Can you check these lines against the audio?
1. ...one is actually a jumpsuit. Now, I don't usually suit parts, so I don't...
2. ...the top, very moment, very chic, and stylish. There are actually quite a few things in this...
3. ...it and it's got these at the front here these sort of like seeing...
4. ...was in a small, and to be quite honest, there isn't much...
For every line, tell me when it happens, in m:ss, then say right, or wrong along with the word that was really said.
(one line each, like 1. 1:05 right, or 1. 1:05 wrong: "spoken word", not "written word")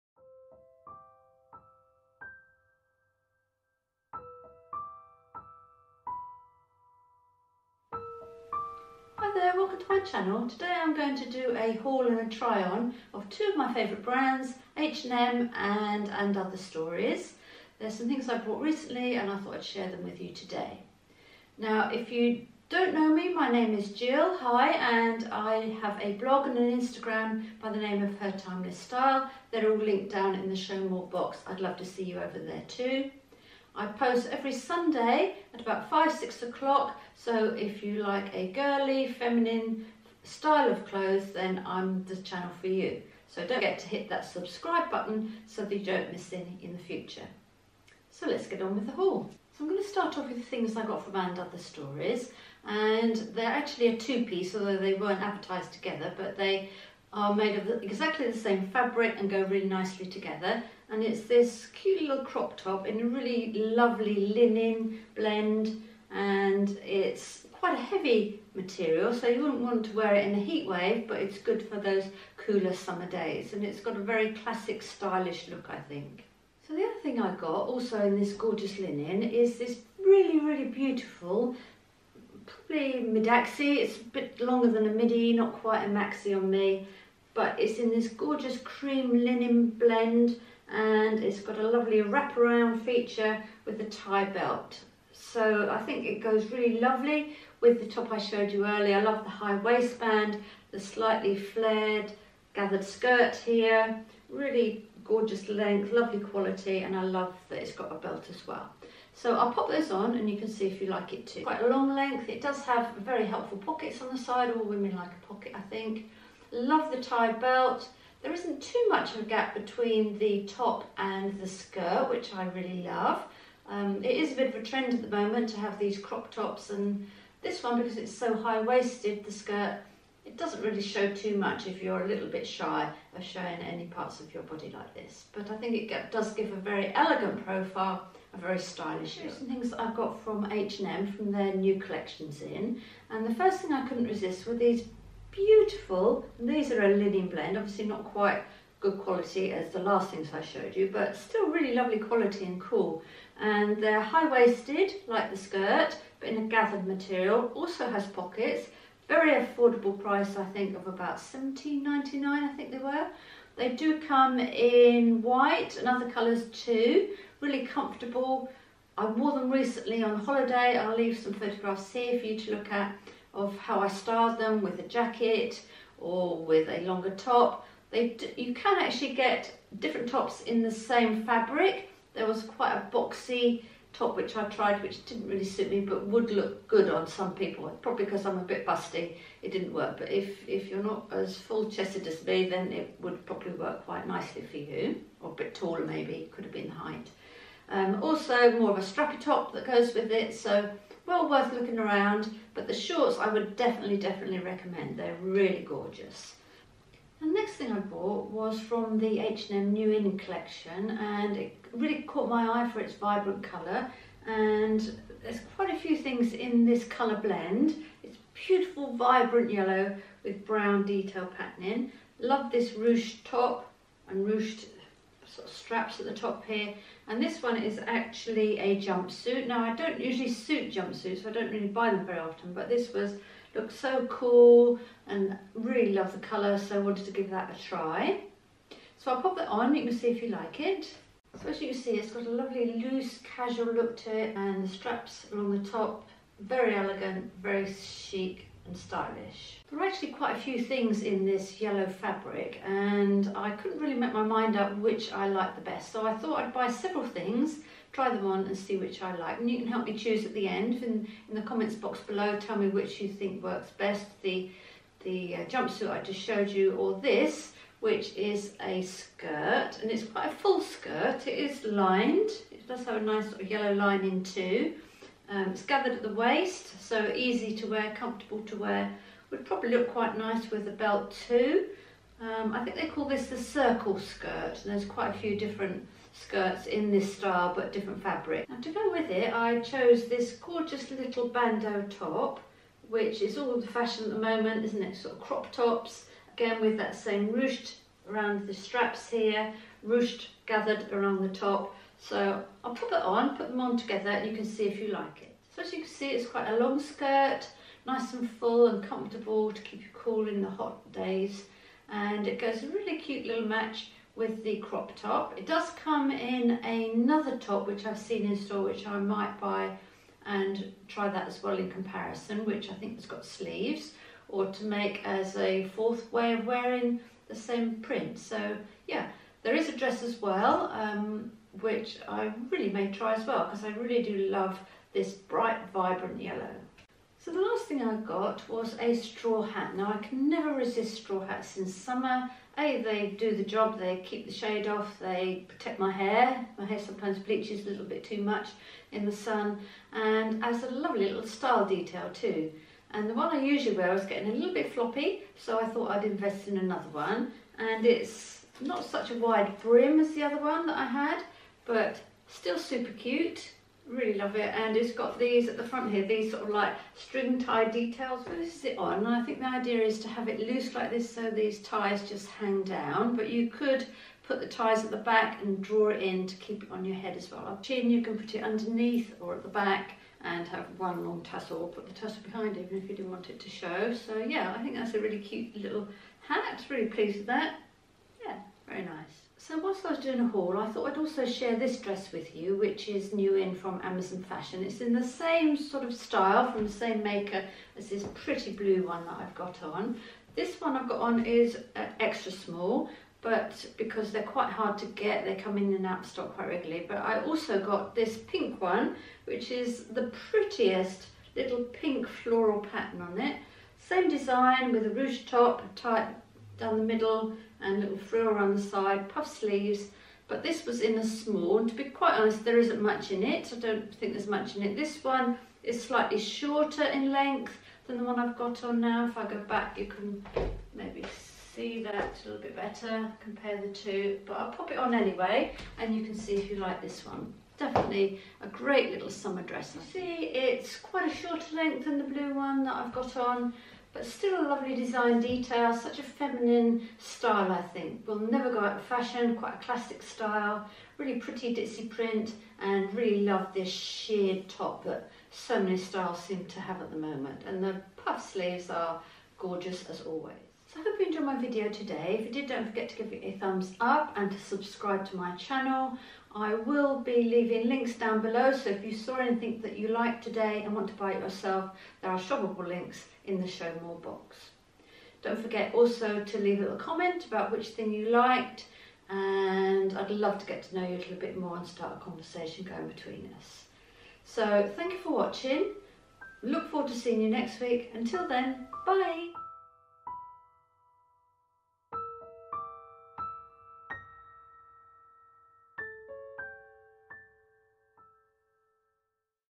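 1. 3:47 wrong: "jumpsuits", not "parts"
2. 4:05 wrong: "elegant", not "moment"
3. 6:04 wrong: "string", not "seeing"
4. 7:00 right.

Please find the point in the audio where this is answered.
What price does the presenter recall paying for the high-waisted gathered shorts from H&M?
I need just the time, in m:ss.
2:41.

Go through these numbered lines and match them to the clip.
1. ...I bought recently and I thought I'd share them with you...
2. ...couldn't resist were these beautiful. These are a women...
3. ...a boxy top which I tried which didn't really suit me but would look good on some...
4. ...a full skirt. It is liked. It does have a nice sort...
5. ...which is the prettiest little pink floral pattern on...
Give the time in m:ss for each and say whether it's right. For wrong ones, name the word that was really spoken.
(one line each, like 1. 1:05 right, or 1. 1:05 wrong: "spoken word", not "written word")
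1. 0:18 right
2. 2:23 wrong: "linen", not "women"
3. 3:02 right
4. 4:30 wrong: "lined", not "liked"
5. 6:49 right.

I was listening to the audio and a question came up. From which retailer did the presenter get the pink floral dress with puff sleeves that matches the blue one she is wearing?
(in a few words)
Amazon Fashion.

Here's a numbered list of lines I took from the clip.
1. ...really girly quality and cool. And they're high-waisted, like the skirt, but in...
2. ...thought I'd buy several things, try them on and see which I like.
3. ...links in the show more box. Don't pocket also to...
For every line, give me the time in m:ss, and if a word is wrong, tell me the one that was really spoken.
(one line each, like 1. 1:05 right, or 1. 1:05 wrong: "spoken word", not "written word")
1. 2:31 wrong: "lovely", not "girly"
2. 4:16 right
3. 7:52 wrong: "forget", not "pocket".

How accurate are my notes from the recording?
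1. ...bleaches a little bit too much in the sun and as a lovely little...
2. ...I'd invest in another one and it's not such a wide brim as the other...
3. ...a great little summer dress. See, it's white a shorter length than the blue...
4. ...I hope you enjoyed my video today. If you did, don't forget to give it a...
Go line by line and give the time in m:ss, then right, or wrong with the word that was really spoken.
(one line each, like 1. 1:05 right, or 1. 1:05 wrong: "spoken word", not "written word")
1. 5:47 right
2. 5:55 right
3. 7:18 wrong: "quite", not "white"
4. 7:40 right.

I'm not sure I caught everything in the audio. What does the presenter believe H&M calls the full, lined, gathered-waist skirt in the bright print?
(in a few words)
Circle skirt.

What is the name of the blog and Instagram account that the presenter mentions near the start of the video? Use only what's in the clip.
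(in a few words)
Her Timeless Style.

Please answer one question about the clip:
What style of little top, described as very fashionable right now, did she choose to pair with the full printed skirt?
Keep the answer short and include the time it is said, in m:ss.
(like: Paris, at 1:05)
Bandeau top, at 4:51.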